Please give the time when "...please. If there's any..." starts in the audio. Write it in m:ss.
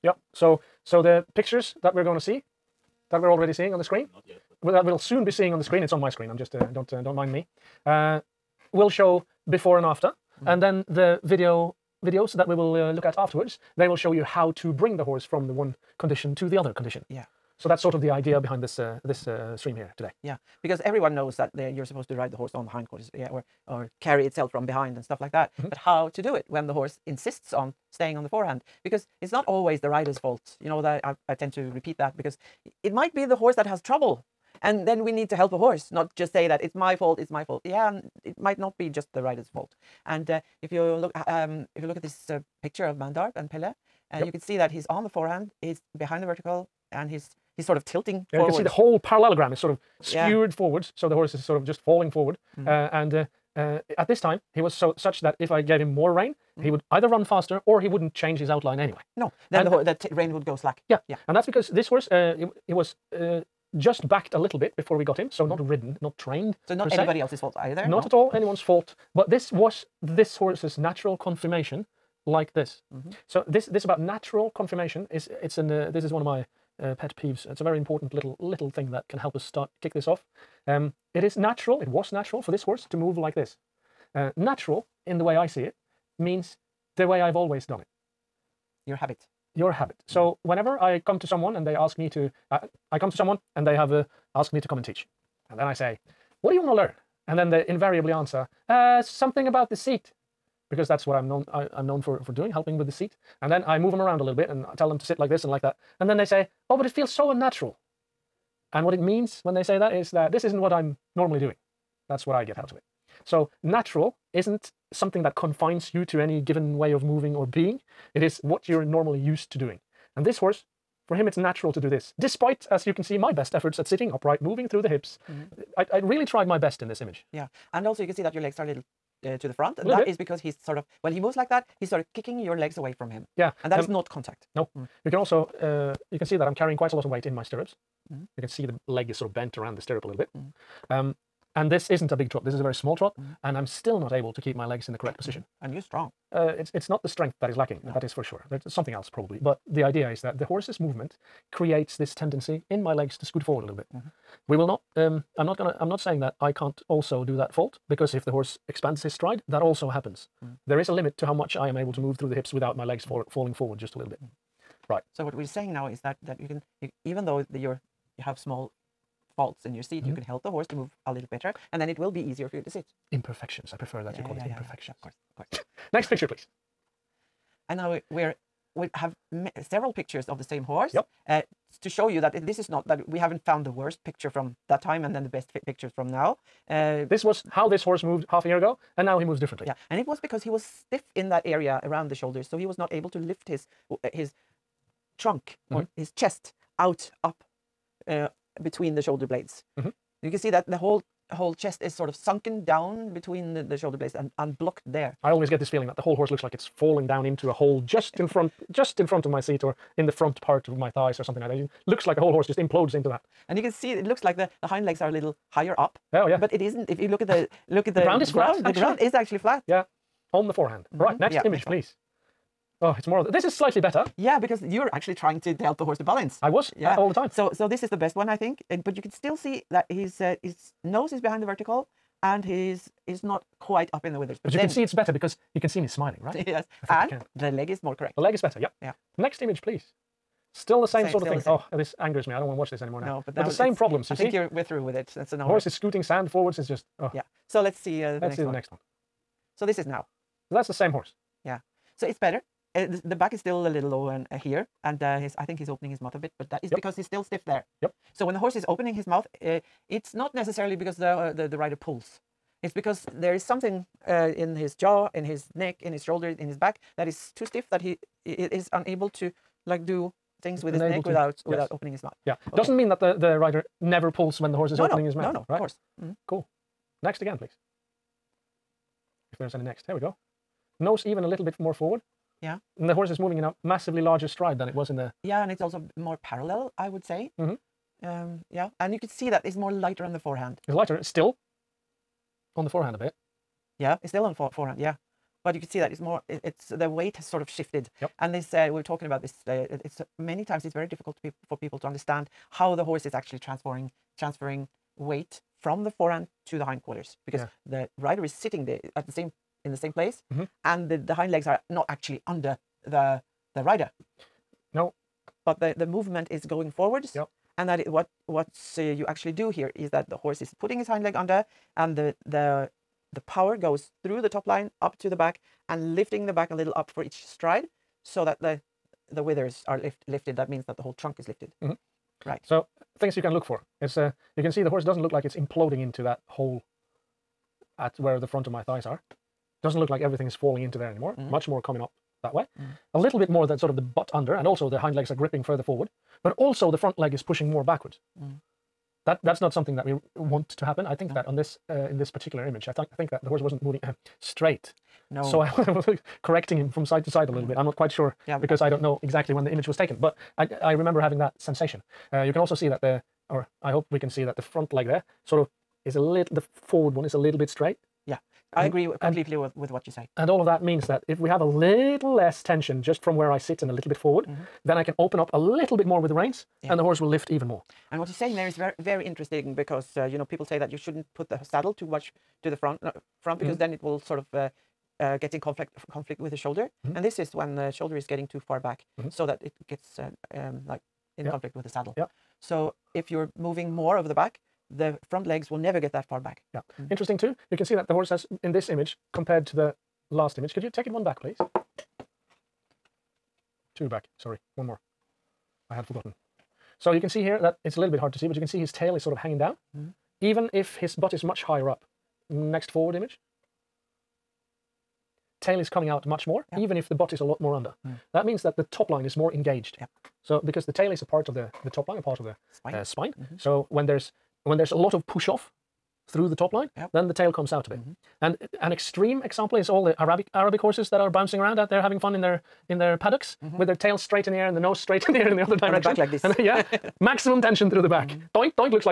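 4:37.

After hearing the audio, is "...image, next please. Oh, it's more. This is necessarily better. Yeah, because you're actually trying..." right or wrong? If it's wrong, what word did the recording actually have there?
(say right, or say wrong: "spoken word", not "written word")
wrong: "slightly", not "necessarily".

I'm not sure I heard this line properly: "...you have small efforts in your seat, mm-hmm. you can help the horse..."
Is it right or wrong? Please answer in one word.
wrong.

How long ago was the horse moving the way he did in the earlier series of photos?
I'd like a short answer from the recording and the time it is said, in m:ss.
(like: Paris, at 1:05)
Half a year, at 3:08.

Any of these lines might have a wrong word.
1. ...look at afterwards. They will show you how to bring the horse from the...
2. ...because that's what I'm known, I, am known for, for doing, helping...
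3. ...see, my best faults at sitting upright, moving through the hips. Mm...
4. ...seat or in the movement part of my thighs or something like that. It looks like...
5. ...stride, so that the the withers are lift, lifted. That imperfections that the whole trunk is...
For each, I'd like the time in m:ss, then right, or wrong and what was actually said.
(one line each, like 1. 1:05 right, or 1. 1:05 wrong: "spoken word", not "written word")
1. 0:12 right
2. 1:40 right
3. 2:03 wrong: "efforts", not "faults"
4. 3:29 wrong: "front", not "movement"
5. 5:27 wrong: "means", not "imperfections".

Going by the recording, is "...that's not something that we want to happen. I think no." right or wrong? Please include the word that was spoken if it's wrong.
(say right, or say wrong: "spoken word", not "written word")
right.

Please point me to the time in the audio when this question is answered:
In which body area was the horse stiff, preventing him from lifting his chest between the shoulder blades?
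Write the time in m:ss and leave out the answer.
3:11.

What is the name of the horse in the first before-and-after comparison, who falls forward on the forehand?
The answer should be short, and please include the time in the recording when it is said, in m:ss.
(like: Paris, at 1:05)
Pelle, at 0:43.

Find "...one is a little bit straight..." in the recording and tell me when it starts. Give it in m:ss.
6:06.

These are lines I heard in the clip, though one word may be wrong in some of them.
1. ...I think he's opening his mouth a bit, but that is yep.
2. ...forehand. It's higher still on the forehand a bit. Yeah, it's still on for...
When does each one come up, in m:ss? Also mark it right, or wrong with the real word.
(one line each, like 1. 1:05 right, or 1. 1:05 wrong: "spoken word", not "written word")
1. 4:15 right
2. 4:50 wrong: "lighter", not "higher".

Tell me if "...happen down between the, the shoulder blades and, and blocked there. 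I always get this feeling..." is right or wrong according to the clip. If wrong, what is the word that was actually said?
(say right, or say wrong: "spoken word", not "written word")
wrong: "sunken", not "happen".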